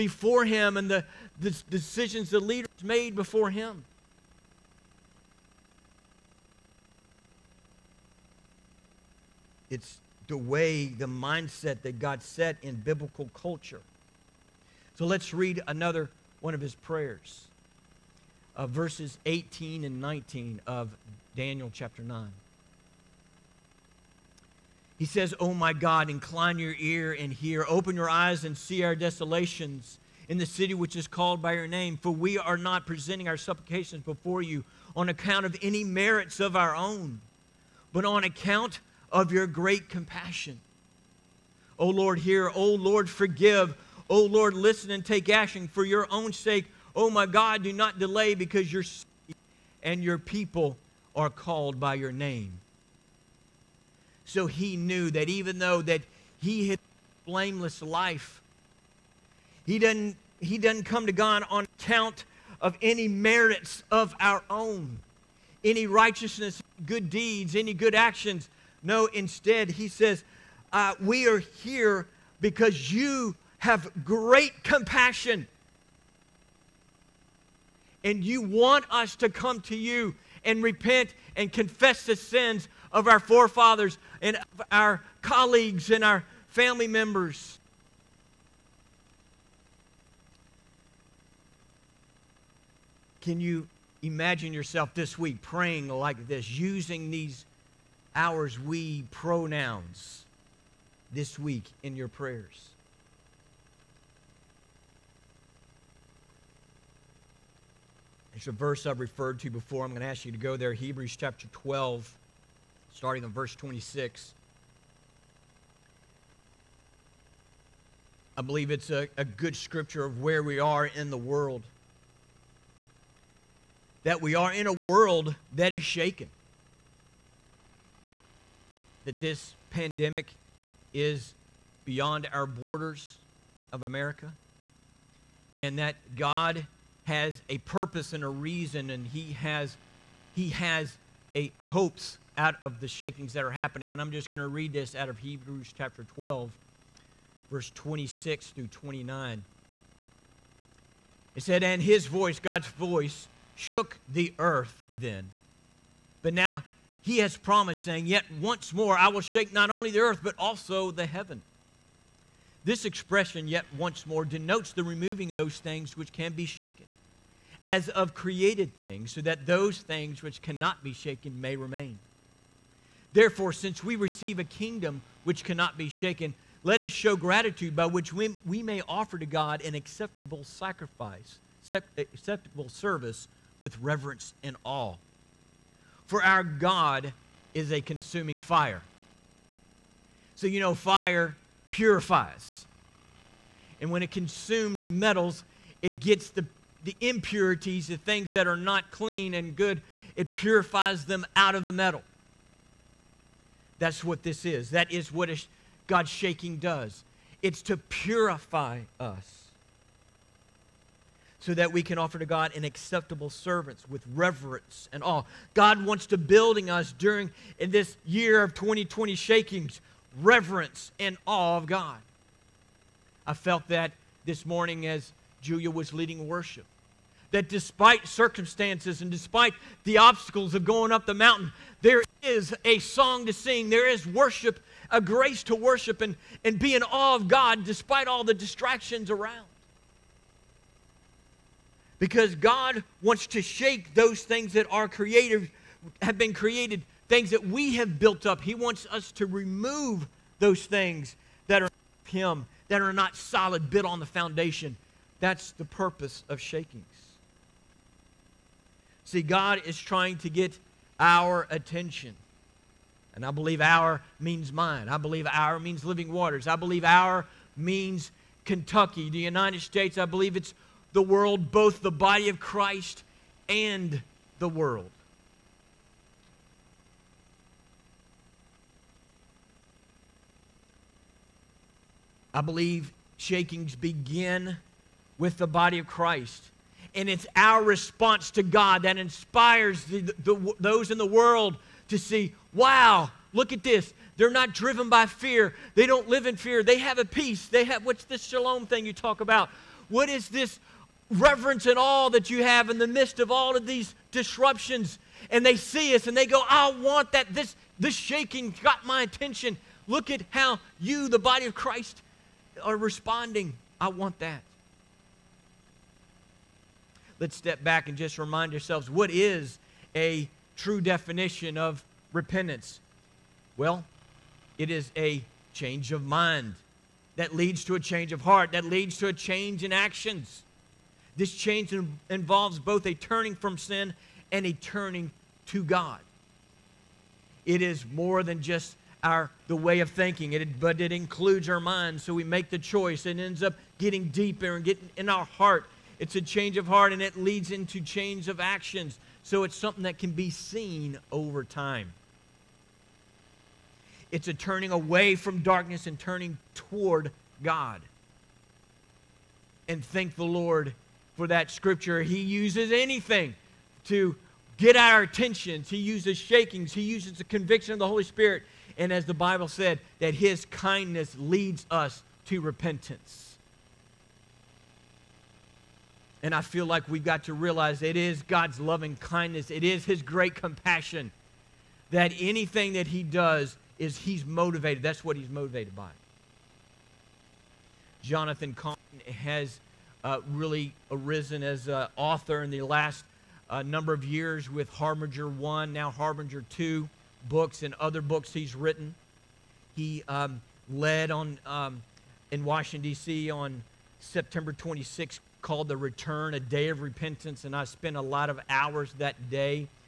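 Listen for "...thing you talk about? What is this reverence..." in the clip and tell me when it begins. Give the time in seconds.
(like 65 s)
298 s.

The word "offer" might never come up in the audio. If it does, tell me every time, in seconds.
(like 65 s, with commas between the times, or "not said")
178 s, 211 s.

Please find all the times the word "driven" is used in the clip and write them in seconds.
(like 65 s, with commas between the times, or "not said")
294 s.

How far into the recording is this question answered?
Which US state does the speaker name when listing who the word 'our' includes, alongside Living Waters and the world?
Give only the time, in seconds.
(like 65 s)
268 s.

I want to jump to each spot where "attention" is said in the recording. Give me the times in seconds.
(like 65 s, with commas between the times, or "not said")
261 s, 309 s, 365 s.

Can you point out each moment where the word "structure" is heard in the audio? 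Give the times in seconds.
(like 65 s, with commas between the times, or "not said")
not said.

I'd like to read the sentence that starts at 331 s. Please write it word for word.
This change in, involves both a turning from sin and a turning to God.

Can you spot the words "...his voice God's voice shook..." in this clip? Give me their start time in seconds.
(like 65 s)
151 s.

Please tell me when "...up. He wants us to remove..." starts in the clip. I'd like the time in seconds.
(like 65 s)
248 s.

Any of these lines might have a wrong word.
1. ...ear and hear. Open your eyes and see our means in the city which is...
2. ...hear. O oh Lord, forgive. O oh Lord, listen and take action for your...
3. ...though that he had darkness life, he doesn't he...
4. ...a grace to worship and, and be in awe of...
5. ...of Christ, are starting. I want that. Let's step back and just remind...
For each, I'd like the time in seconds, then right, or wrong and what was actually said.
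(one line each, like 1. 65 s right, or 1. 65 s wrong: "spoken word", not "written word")
1. 26 s wrong: "desolations", not "means"
2. 42 s right
3. 55 s wrong: "blameless", not "darkness"
4. 234 s right
5. 311 s wrong: "responding", not "starting".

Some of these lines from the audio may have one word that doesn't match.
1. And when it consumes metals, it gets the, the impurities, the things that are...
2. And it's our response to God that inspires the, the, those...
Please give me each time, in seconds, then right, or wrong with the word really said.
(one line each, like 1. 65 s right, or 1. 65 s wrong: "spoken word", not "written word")
1. 193 s right
2. 286 s right.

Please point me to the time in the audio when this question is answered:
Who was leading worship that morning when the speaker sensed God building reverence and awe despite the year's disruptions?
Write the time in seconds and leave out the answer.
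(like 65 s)
225 s.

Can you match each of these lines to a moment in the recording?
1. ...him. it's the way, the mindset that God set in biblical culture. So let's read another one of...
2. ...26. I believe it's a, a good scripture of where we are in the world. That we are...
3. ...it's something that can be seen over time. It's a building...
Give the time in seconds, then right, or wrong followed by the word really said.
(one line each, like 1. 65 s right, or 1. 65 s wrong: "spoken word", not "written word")
1. 3 s right
2. 113 s right
3. 349 s wrong: "turning", not "building".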